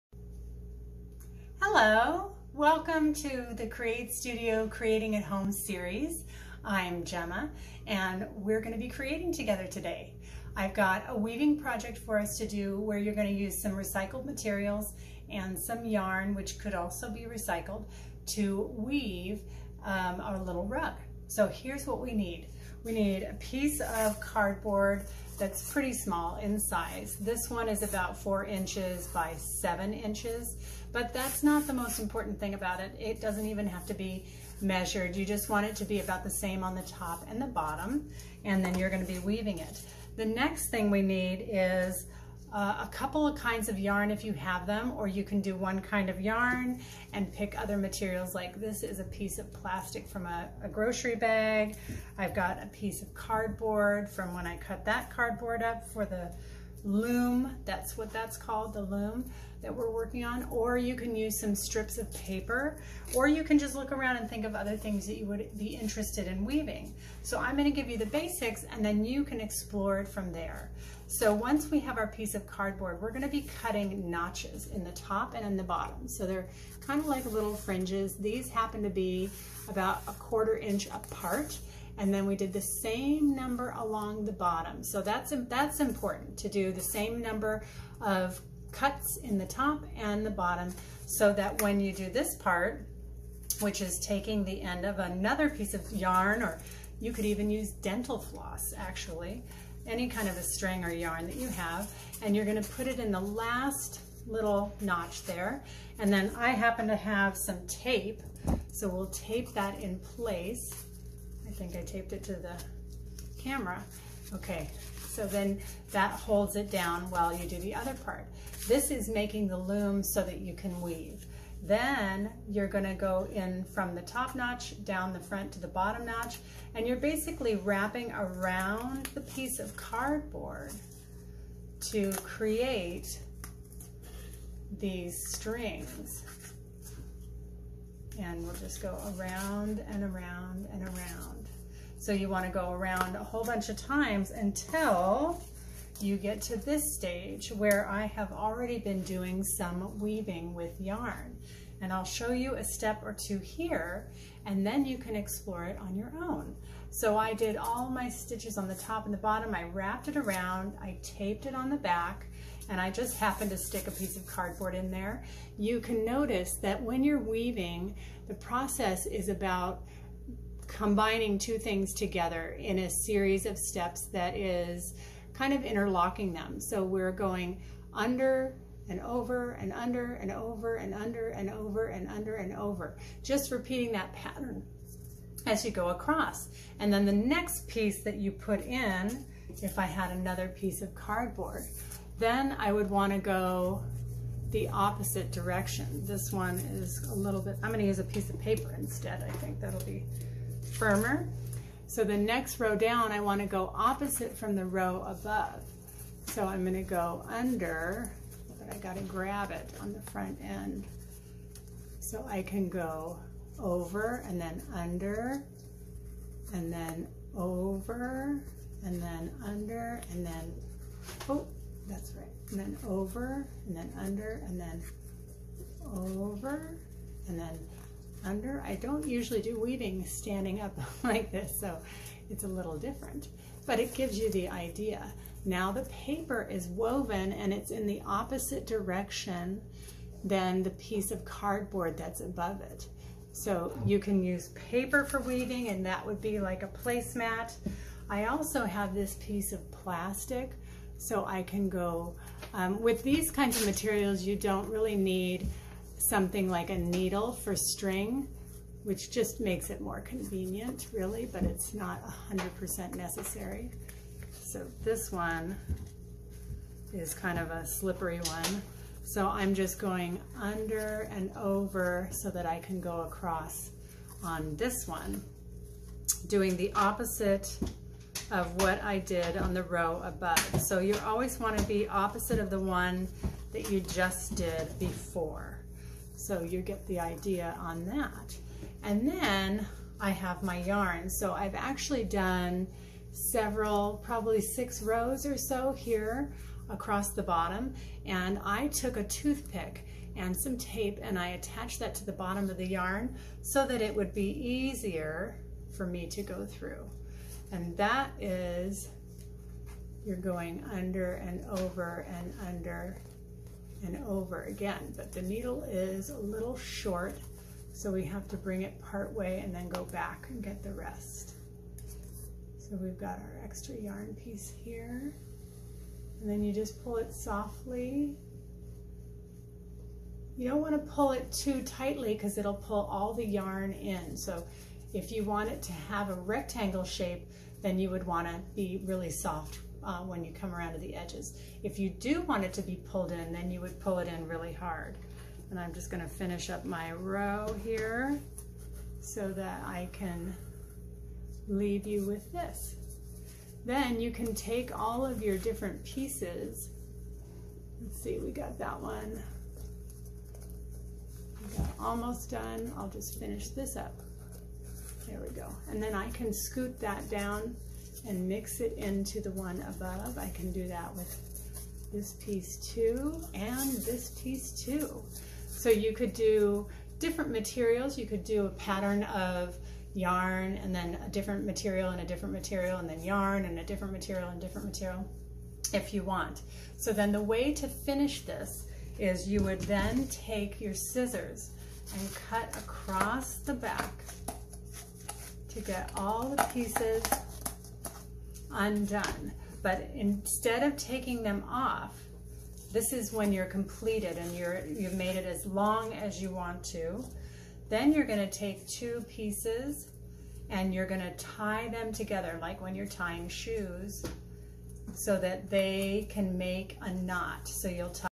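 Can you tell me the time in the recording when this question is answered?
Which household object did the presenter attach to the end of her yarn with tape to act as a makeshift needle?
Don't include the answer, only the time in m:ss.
4:59.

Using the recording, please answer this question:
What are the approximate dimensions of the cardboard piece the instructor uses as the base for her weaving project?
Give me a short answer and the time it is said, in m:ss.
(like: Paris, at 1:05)
4 inches by 7 inches, at 0:28.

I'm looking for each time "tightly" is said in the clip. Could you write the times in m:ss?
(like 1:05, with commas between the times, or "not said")
5:31.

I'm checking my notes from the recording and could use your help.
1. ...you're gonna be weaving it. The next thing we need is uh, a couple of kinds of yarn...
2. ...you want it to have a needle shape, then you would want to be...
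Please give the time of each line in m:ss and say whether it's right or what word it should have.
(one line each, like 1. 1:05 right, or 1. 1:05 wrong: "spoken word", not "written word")
1. 0:38 right
2. 5:35 wrong: "rectangle", not "needle".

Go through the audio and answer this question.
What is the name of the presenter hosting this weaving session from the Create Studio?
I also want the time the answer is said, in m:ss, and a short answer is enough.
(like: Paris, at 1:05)
Jemma, at 0:07.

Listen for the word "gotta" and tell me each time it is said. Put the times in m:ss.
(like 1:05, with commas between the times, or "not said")
3:28.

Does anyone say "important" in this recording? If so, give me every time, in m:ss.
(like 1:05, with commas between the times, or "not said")
0:31, 1:25.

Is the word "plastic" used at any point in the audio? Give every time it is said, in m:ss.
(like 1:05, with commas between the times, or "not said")
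0:49, 4:09.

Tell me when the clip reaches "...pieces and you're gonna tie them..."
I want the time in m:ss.
6:49.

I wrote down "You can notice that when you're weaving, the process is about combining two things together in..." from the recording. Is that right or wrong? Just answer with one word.
right.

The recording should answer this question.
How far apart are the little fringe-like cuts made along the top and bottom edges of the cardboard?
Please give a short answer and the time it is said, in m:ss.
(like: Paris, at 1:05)
a quarter inch, at 1:20.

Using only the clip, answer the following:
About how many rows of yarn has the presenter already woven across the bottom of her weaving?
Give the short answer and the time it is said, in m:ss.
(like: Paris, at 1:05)
6, at 4:54.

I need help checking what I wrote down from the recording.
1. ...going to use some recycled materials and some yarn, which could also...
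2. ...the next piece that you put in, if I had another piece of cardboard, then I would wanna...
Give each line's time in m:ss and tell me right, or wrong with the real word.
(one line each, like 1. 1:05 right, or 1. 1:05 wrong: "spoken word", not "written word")
1. 0:13 right
2. 3:07 right.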